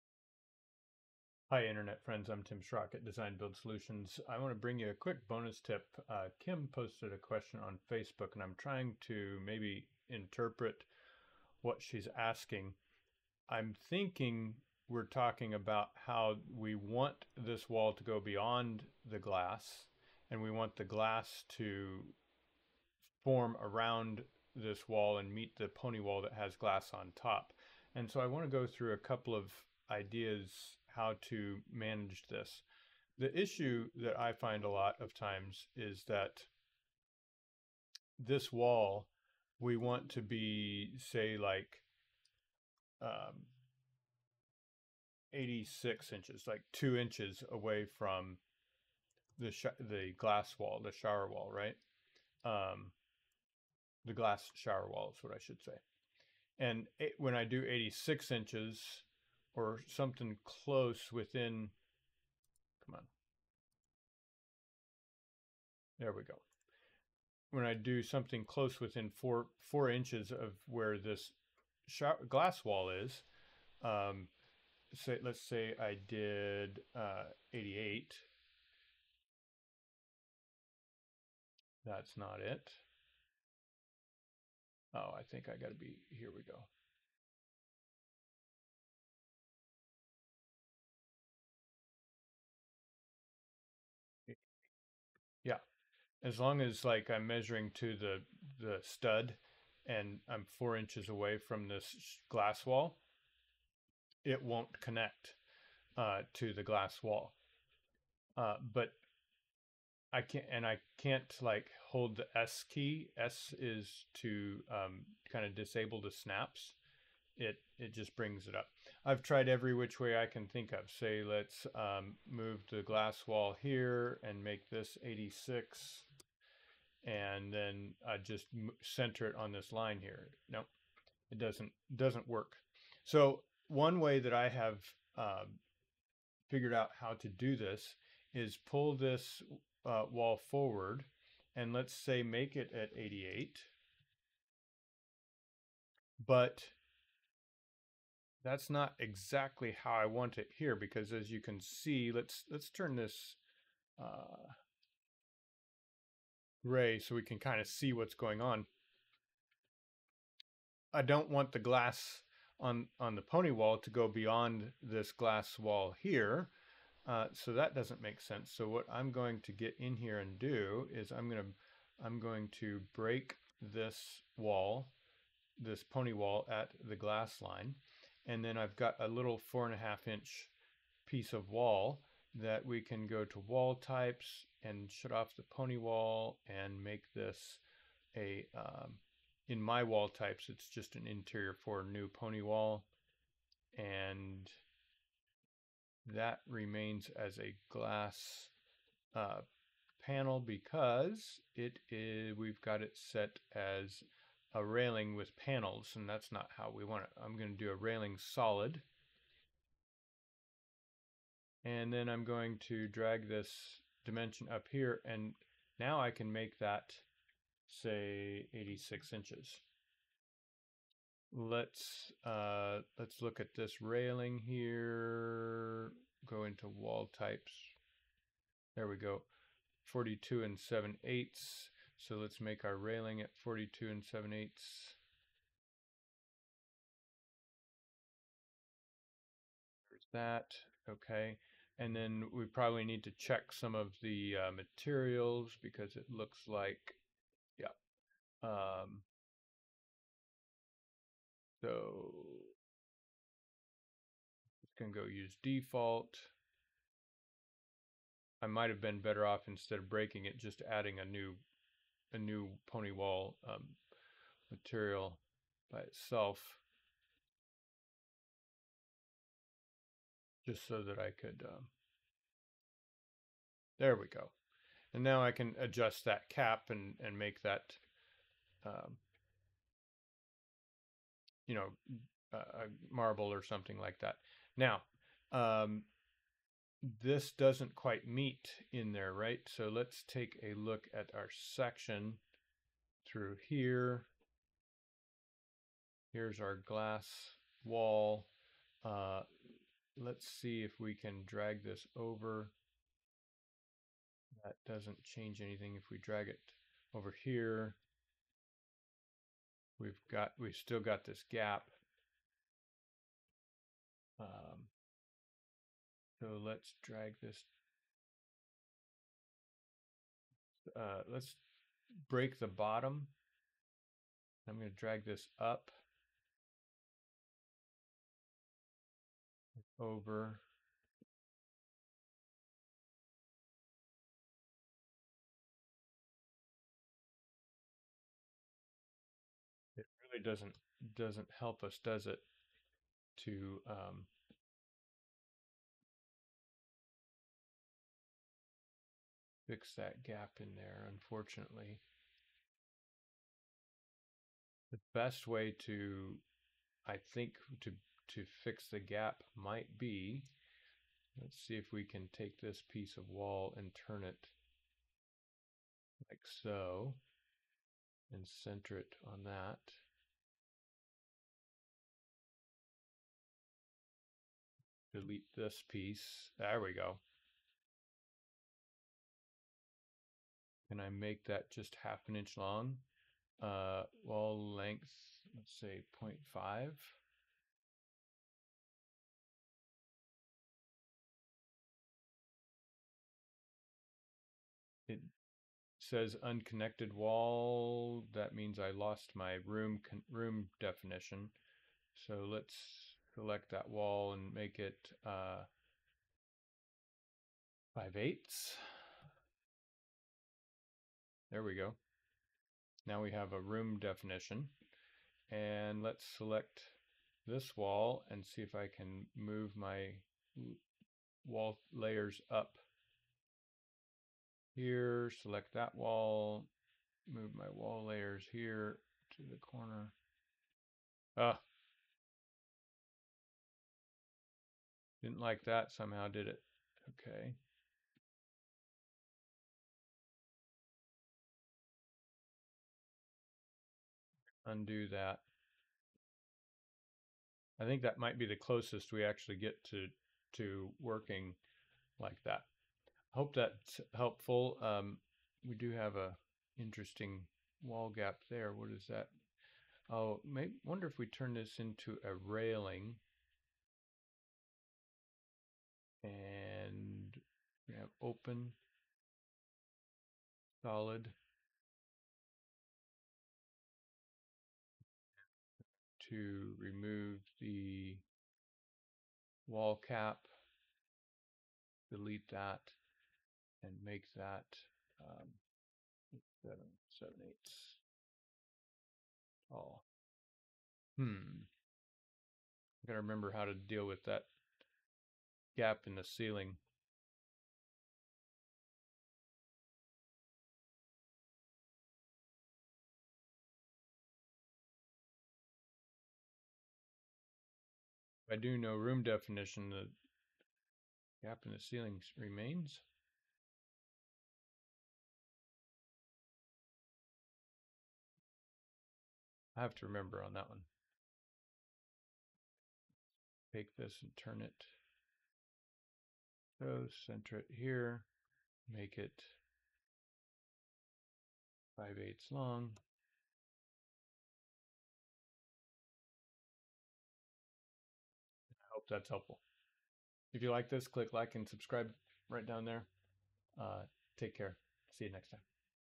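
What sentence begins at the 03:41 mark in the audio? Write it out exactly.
Let's, uh, let's look at this railing here, go into wall types.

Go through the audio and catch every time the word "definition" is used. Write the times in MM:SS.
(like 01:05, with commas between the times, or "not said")
06:40, 06:53, 08:29.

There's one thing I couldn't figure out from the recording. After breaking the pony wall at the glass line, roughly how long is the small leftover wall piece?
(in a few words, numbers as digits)
4.5 inches.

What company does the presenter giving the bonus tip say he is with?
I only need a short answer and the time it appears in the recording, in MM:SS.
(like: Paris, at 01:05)
Design Build Solutions, at 00:03.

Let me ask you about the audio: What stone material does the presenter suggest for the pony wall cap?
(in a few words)
Marble.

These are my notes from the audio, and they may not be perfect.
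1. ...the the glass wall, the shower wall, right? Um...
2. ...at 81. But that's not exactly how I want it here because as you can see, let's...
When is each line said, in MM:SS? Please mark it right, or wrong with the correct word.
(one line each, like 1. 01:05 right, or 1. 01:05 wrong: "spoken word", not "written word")
1. 00:49 right
2. 02:22 wrong: "88", not "81".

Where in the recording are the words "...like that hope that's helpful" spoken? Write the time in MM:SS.
07:31.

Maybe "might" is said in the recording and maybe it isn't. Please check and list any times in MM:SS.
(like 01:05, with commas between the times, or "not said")
04:18, 05:59, 07:27.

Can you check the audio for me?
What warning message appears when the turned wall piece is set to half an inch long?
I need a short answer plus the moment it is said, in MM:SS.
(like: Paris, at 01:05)
Unconnected wall, at 06:36.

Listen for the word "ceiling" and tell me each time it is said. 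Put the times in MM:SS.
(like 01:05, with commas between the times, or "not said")
08:16, 08:31.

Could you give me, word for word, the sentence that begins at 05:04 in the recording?
That doesn't change anything if we drag it over here.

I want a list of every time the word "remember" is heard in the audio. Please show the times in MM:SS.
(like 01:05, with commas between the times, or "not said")
08:13, 08:39.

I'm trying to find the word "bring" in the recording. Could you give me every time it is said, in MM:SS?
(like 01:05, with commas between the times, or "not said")
00:04, 01:58.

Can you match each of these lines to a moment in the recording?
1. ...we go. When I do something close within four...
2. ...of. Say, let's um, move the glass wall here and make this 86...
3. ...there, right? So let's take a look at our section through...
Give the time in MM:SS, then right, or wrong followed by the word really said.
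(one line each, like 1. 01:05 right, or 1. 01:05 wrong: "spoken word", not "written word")
1. 01:06 right
2. 02:00 right
3. 04:48 right.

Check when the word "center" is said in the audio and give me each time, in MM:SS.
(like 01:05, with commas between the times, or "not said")
02:08, 06:08, 08:47.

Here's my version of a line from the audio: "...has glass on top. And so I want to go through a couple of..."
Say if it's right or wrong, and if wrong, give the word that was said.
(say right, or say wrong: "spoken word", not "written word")
right.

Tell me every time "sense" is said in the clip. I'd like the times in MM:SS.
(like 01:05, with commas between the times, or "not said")
02:48.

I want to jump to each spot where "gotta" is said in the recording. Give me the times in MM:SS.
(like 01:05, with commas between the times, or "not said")
08:12.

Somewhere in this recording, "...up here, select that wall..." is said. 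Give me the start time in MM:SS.
07:02.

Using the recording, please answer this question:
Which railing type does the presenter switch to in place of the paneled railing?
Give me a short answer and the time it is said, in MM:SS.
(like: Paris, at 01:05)
Railing solid, at 03:27.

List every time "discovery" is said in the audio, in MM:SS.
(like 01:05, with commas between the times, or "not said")
not said.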